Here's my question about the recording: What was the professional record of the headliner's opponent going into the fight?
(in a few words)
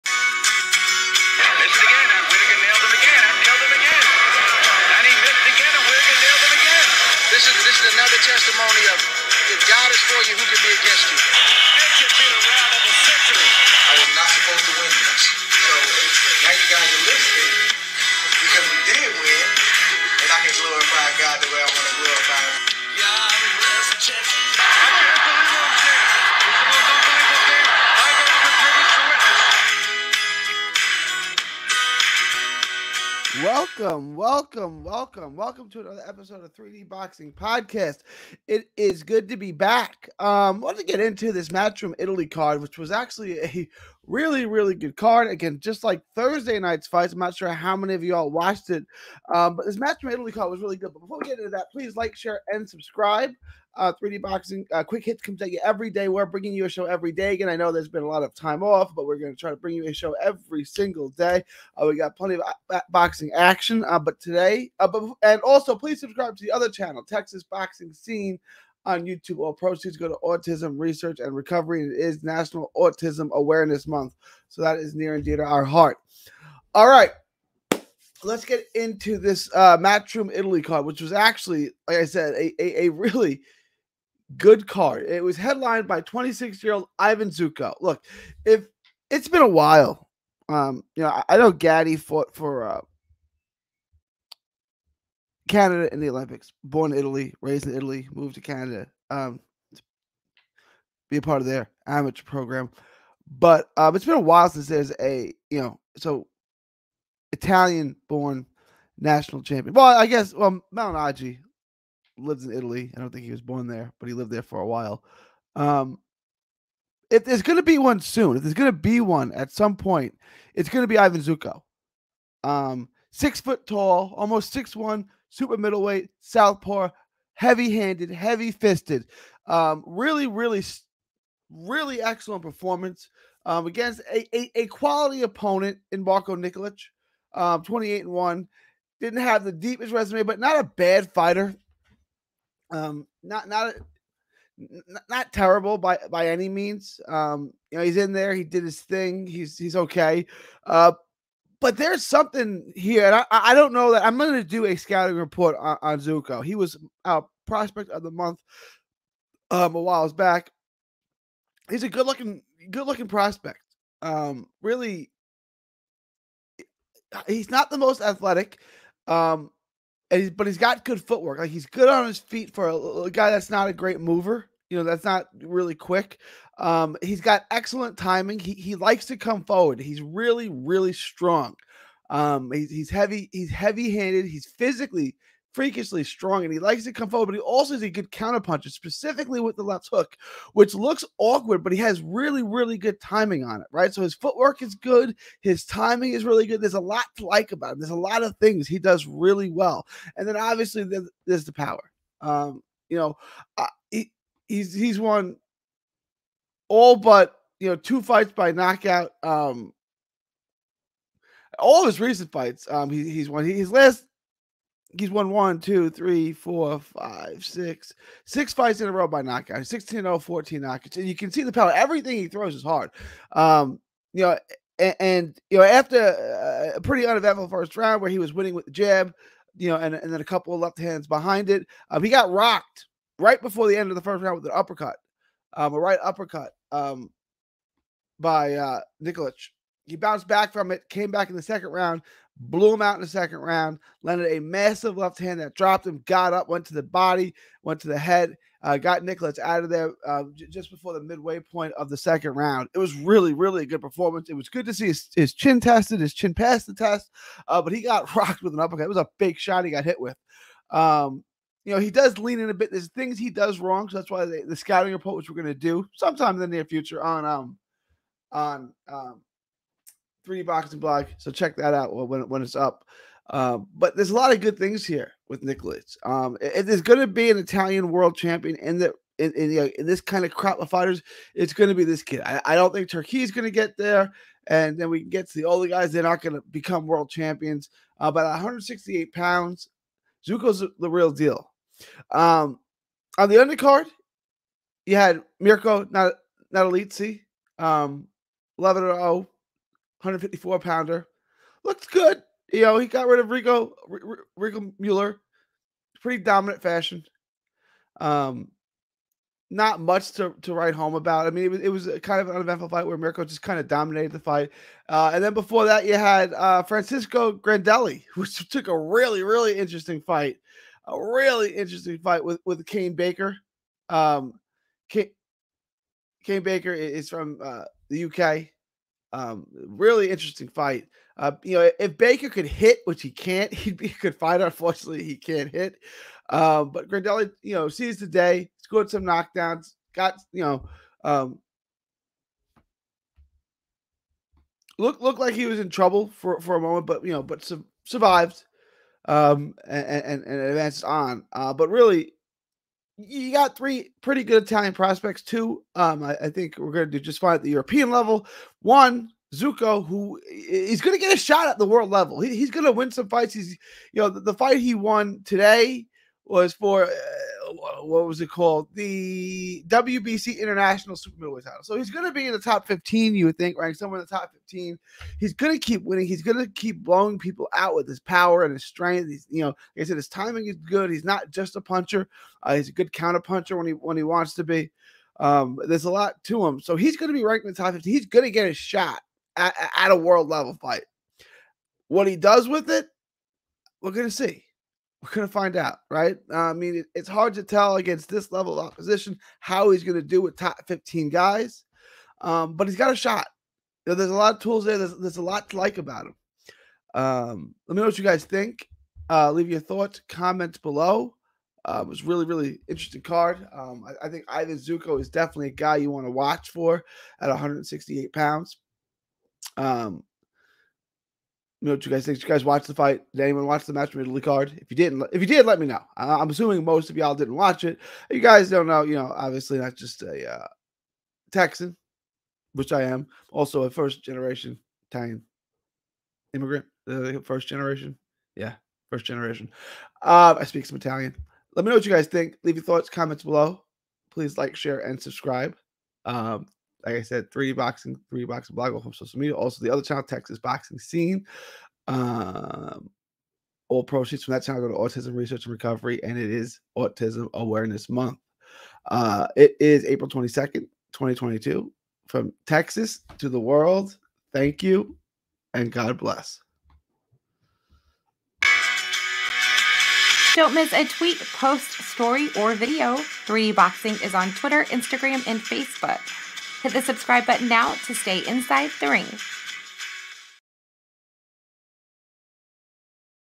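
28-1.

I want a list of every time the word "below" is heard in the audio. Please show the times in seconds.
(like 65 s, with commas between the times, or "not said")
410 s, 443 s.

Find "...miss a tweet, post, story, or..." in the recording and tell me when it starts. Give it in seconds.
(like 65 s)
470 s.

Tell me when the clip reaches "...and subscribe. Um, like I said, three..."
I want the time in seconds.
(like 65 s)
444 s.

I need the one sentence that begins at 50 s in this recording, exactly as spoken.
But before we get into that, please like, share, and subscribe.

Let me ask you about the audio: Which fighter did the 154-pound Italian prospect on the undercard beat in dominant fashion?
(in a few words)
Rico Mueller.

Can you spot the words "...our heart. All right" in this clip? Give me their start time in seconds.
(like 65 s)
75 s.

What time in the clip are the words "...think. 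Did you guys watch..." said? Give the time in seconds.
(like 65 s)
422 s.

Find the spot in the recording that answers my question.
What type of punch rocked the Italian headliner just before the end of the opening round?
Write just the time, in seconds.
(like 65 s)
235 s.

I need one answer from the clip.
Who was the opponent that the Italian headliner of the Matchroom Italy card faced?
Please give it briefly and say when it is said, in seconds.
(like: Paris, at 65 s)
Marko Nikolic, at 136 s.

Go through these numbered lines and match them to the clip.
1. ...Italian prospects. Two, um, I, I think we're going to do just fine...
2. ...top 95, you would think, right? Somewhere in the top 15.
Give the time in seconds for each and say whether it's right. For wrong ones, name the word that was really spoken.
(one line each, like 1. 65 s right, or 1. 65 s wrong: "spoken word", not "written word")
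1. 354 s right
2. 372 s wrong: "15", not "95".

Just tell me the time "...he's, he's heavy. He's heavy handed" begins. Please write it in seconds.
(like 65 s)
182 s.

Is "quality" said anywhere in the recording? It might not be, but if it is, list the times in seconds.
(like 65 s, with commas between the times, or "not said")
134 s.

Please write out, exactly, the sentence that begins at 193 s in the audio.
So his footwork is good, his timing is really good.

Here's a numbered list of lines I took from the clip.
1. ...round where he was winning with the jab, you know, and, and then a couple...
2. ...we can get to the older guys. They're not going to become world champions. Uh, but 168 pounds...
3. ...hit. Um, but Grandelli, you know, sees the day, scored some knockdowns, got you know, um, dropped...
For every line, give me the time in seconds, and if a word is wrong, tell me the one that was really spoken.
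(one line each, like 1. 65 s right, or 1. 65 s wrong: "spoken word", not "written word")
1. 227 s right
2. 284 s right
3. 335 s wrong: "looked", not "dropped".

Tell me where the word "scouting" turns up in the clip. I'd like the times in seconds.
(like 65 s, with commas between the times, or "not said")
154 s, 264 s.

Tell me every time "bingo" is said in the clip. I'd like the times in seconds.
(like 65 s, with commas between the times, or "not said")
not said.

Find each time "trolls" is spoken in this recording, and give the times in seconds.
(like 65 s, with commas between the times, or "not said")
not said.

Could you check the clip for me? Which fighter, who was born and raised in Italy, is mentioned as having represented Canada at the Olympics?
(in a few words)
Gatti.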